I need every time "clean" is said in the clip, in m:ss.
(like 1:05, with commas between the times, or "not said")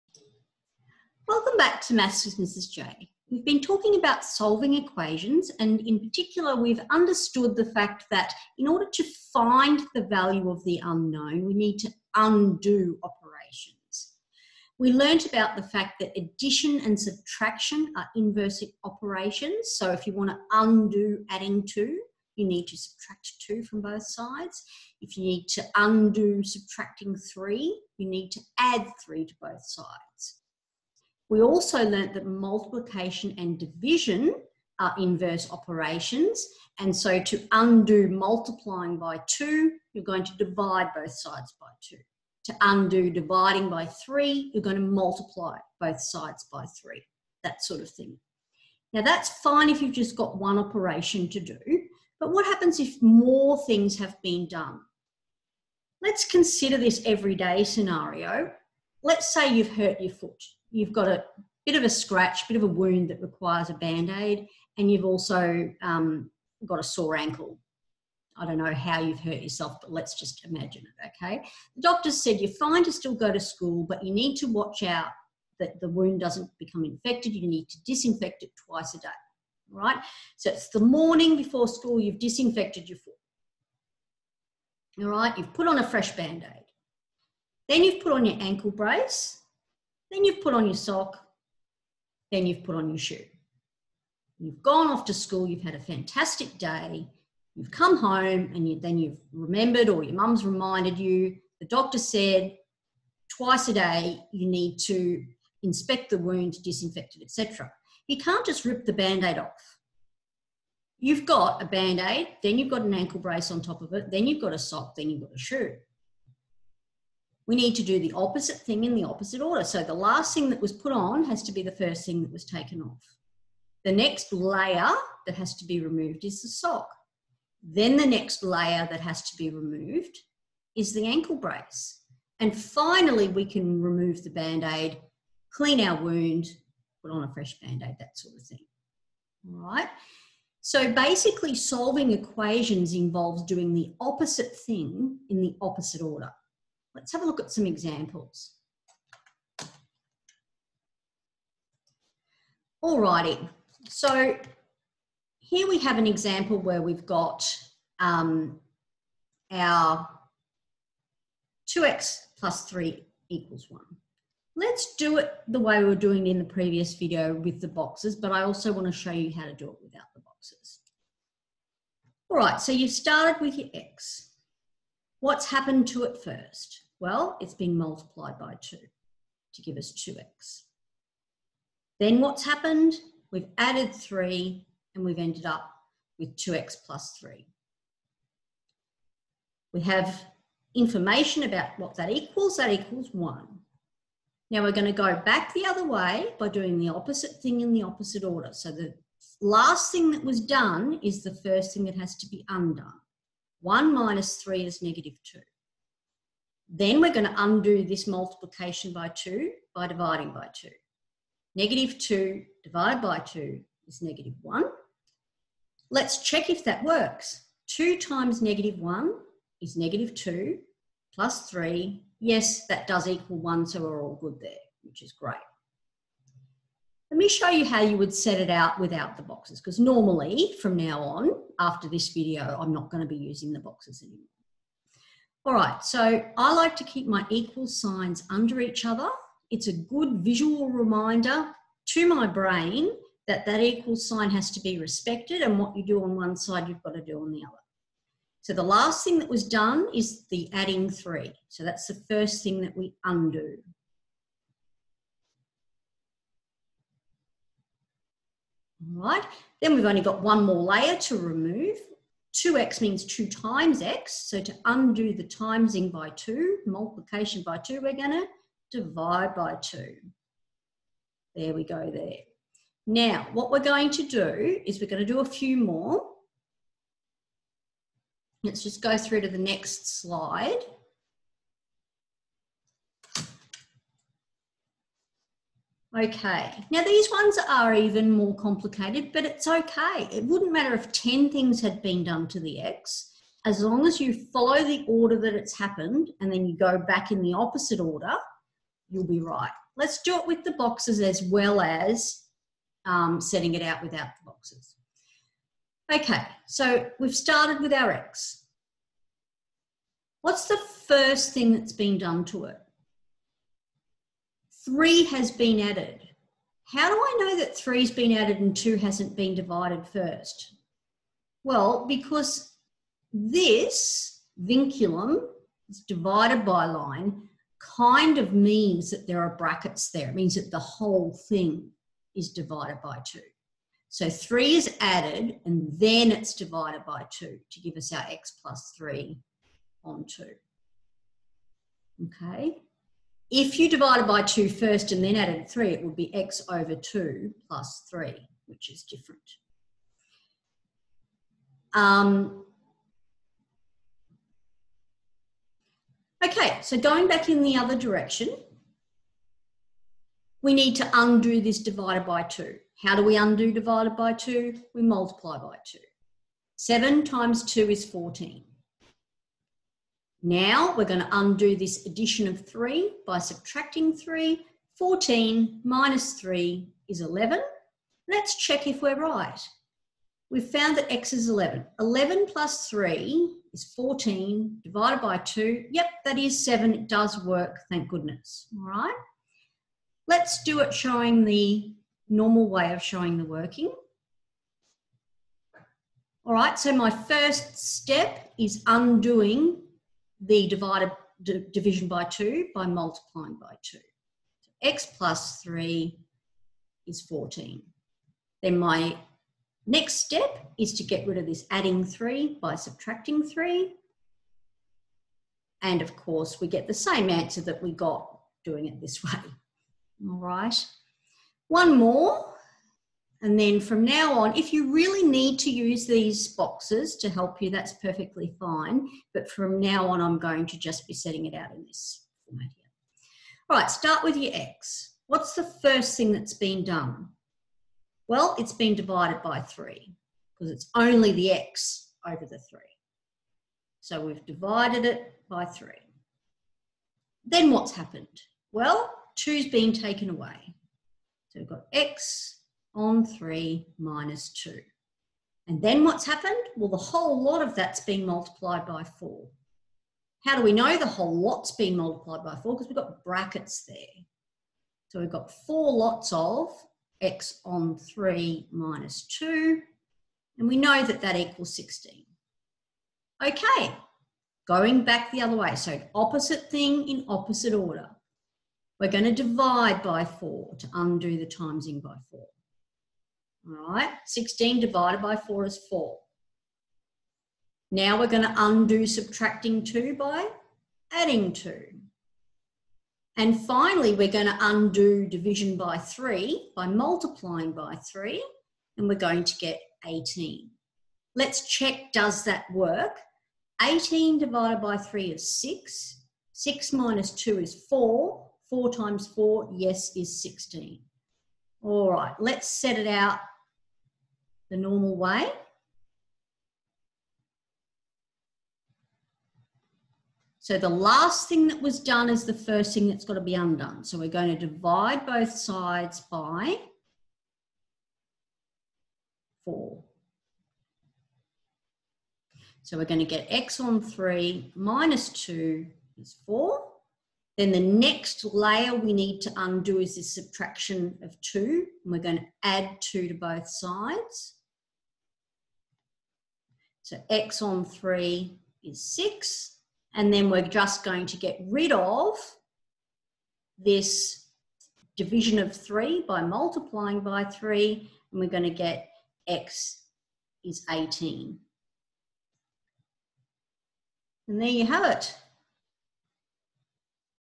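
2:15.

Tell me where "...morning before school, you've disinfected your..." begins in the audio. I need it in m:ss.
1:20.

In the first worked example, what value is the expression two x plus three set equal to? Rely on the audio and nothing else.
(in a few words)
1.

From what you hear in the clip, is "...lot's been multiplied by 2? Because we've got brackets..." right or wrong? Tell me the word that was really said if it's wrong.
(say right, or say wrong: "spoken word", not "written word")
wrong: "4", not "2".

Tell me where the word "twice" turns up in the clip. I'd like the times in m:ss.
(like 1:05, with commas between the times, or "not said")
1:18, 1:43.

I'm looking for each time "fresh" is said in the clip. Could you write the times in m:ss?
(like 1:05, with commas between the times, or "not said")
1:25, 2:17.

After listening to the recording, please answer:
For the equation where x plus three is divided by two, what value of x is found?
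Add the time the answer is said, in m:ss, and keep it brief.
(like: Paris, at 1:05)
11, at 6:14.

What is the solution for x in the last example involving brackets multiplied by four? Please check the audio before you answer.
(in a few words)
18.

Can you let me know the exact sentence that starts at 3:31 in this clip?
Negative 2 divided by 2 is negative 1.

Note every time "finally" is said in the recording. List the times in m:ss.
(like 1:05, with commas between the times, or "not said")
2:12, 8:13.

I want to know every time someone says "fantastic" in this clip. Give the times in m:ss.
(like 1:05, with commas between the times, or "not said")
1:35.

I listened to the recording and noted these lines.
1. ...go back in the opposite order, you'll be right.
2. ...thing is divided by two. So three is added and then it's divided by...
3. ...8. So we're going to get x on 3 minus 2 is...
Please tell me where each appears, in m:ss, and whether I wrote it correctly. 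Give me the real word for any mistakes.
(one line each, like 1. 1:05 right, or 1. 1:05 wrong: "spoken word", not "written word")
1. 4:56 right
2. 5:31 right
3. 8:49 wrong: "4", not "8".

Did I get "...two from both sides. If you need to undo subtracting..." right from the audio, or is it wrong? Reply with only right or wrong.
right.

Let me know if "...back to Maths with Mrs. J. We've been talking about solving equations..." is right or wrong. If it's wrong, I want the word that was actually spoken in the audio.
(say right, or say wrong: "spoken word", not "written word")
right.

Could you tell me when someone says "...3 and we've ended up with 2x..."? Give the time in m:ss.
3:03.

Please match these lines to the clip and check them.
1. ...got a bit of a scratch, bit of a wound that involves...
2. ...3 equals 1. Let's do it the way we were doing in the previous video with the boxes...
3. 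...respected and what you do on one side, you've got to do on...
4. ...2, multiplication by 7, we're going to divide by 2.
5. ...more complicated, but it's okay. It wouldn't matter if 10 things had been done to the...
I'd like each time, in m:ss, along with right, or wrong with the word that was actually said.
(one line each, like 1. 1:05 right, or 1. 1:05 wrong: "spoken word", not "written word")
1. 1:00 wrong: "requires", not "involves"
2. 2:42 right
3. 4:04 right
4. 4:26 wrong: "2", not "7"
5. 4:48 right.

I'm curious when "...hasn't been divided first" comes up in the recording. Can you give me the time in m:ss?
5:18.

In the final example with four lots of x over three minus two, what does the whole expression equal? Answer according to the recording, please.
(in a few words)
16.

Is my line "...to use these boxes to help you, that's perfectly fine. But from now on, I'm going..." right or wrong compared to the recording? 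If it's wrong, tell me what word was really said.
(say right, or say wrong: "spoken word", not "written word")
right.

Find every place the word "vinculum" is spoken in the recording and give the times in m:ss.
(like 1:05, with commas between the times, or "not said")
5:24.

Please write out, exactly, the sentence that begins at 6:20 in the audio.
We've found that x is 11.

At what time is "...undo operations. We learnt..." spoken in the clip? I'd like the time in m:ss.
0:12.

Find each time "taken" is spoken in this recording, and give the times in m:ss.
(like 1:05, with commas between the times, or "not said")
2:02, 7:29.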